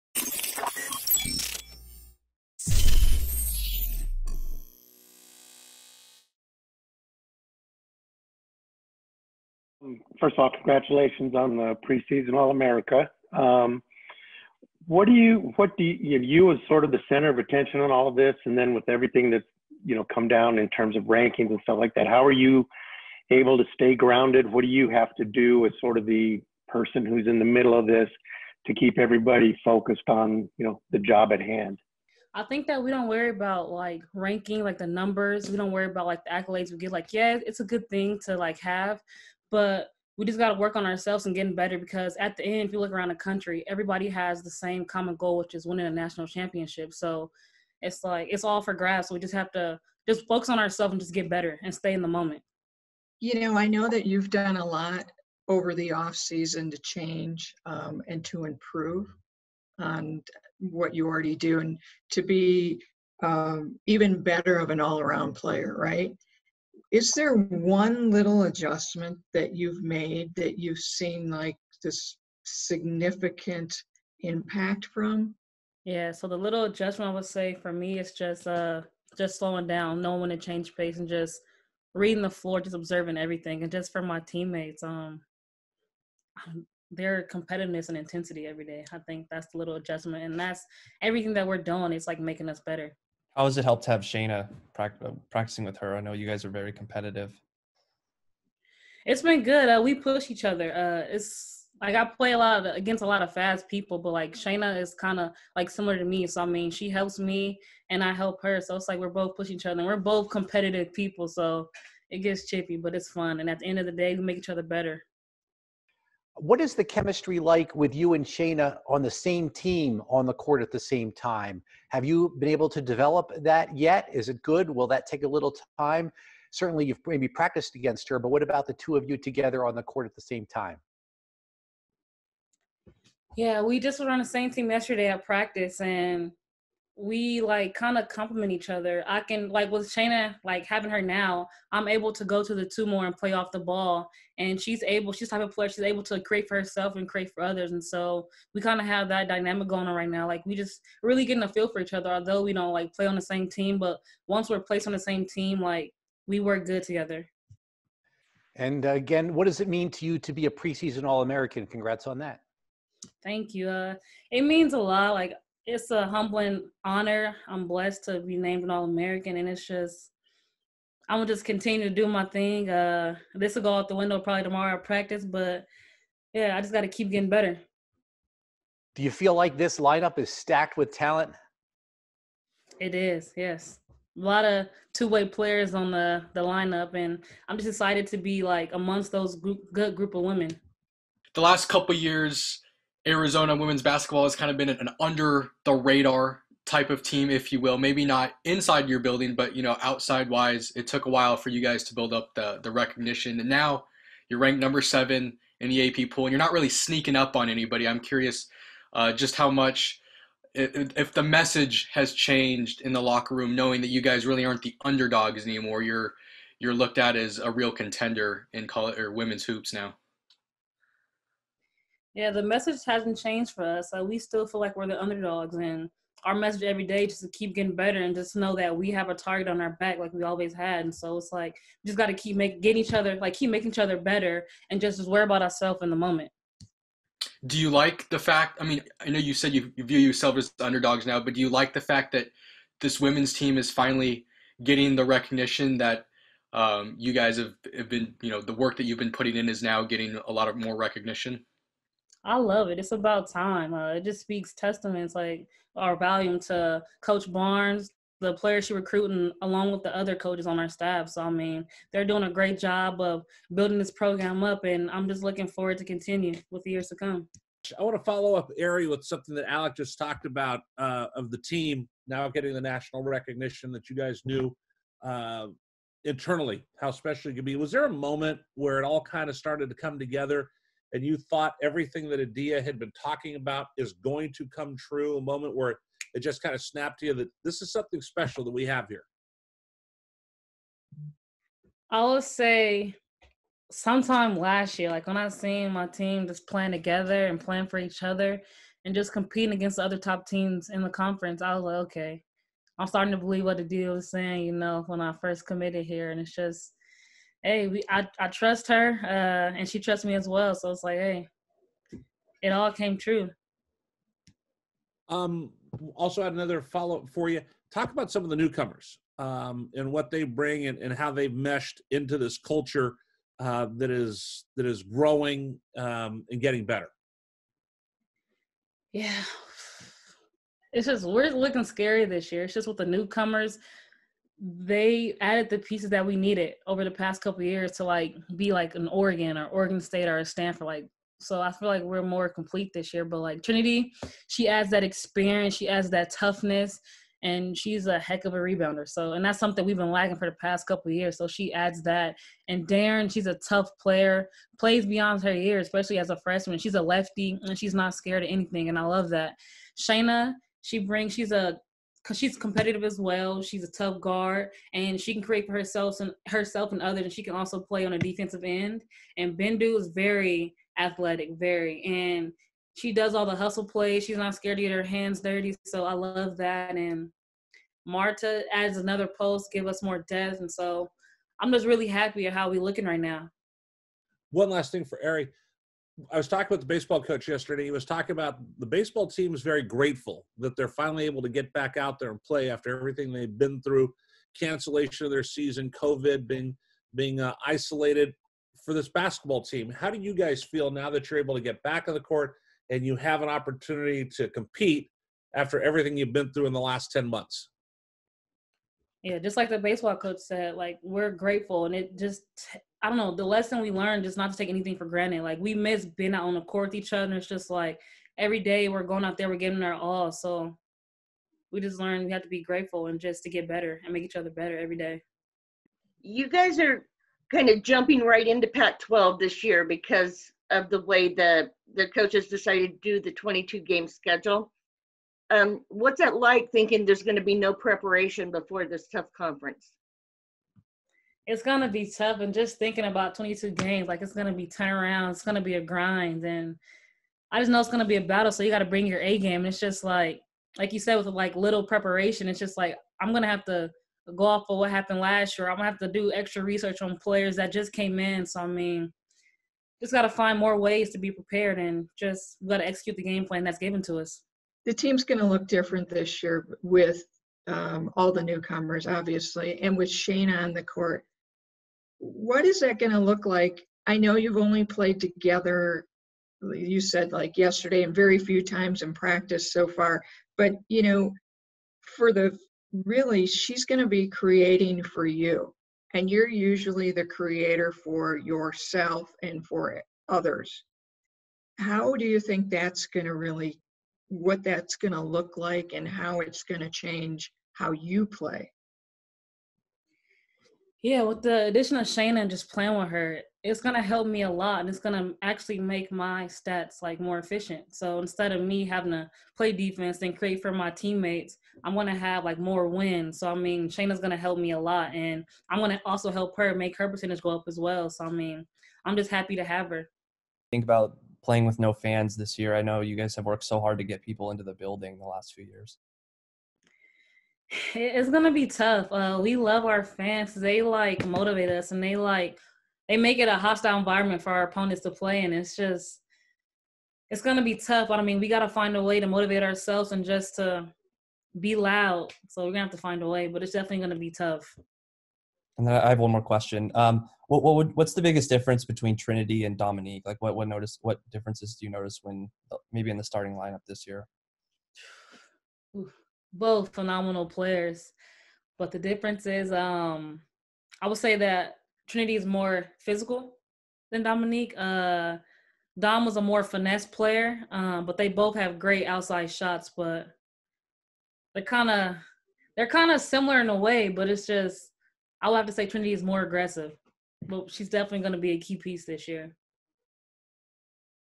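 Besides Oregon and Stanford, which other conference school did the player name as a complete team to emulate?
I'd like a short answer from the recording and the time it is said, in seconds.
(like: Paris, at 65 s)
Oregon State, at 339 s.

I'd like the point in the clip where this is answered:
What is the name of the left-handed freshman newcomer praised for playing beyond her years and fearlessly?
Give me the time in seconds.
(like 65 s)
352 s.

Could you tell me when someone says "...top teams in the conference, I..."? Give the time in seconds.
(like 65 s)
299 s.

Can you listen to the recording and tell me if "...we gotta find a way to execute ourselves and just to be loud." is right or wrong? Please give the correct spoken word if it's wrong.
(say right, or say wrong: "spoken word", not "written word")
wrong: "motivate", not "execute".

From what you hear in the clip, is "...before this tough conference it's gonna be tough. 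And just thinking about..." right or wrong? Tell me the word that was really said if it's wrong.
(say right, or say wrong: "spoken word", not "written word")
right.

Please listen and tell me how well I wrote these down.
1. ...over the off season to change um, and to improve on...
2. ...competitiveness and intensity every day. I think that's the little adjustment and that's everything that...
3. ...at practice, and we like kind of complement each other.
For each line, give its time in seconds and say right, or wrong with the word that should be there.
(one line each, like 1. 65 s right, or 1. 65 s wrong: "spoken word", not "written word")
1. 55 s right
2. 87 s right
3. 135 s right.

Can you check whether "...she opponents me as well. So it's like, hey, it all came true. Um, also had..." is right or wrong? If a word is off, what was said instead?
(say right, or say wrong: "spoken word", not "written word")
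wrong: "trusts", not "opponents".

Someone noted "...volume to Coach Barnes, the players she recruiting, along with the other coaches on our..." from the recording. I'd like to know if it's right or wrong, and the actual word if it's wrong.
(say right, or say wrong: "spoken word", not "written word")
right.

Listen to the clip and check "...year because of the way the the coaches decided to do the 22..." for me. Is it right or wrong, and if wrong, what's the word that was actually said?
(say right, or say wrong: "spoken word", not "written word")
right.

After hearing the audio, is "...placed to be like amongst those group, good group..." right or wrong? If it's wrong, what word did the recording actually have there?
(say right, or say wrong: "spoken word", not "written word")
wrong: "excited", not "placed".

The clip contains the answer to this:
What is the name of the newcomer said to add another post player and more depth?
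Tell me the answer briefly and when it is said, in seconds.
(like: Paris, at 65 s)
Marta, at 377 s.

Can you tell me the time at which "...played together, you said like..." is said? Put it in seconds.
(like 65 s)
474 s.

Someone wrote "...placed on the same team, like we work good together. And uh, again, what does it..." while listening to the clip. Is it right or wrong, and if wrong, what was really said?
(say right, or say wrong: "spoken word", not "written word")
right.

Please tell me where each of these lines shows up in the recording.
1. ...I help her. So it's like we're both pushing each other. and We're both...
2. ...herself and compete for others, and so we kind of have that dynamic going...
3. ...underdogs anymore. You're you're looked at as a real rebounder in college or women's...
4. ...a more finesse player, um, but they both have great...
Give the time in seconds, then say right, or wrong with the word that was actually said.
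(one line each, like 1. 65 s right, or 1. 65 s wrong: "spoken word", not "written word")
1. 108 s right
2. 146 s wrong: "create", not "compete"
3. 214 s wrong: "contender", not "rebounder"
4. 566 s right.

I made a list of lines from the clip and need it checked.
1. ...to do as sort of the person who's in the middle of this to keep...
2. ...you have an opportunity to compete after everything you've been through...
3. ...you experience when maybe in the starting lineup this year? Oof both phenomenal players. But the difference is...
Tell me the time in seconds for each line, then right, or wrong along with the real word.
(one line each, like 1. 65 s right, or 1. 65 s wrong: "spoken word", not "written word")
1. 25 s right
2. 402 s right
3. 551 s wrong: "notice", not "experience".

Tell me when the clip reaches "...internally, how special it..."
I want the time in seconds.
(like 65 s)
276 s.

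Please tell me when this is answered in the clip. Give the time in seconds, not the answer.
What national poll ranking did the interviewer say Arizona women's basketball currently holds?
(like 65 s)
204 s.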